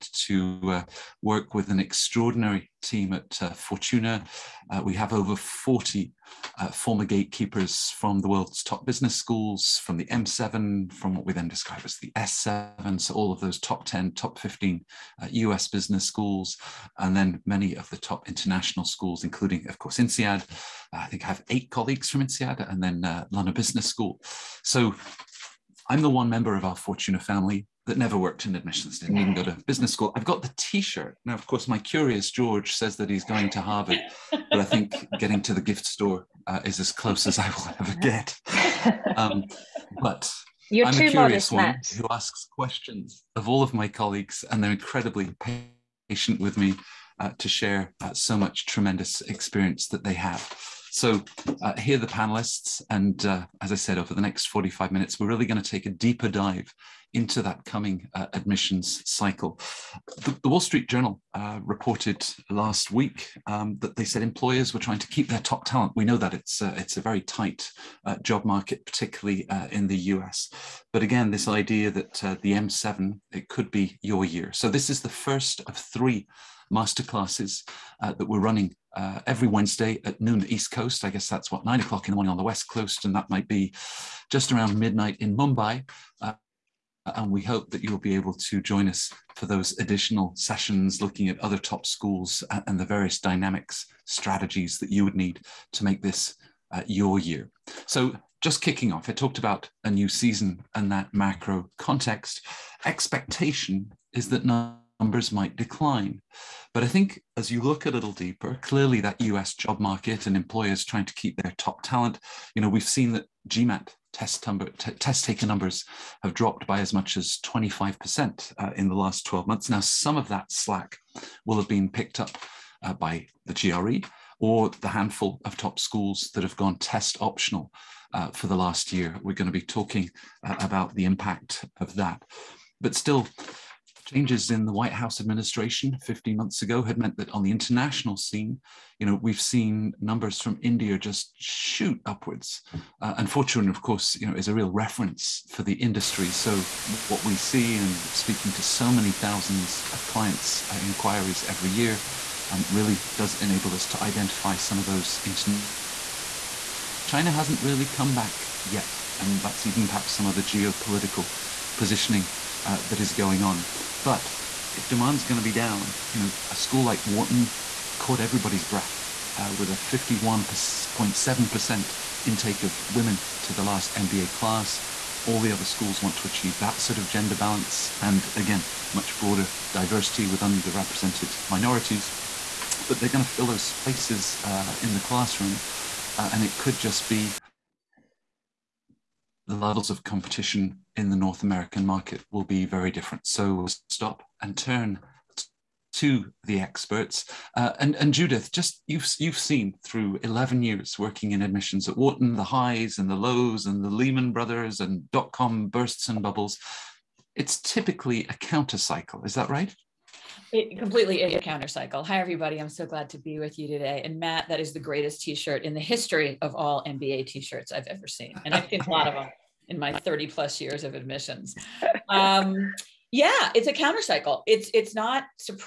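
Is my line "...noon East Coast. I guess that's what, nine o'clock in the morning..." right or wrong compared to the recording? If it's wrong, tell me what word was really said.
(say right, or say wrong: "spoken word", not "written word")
right.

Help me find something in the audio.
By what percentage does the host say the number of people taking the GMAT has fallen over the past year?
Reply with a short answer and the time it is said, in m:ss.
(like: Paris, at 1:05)
25%, at 1:57.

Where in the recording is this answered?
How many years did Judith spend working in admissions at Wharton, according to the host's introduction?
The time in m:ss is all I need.
3:20.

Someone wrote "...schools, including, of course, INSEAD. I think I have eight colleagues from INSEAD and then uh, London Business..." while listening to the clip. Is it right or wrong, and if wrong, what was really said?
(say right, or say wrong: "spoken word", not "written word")
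right.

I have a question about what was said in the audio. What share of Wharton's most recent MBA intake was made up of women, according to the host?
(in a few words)
51.7%.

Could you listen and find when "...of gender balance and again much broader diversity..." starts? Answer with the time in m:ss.
2:56.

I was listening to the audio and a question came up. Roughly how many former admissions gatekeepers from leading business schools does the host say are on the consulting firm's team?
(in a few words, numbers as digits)
over 40.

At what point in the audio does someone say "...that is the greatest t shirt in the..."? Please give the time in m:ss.
3:34.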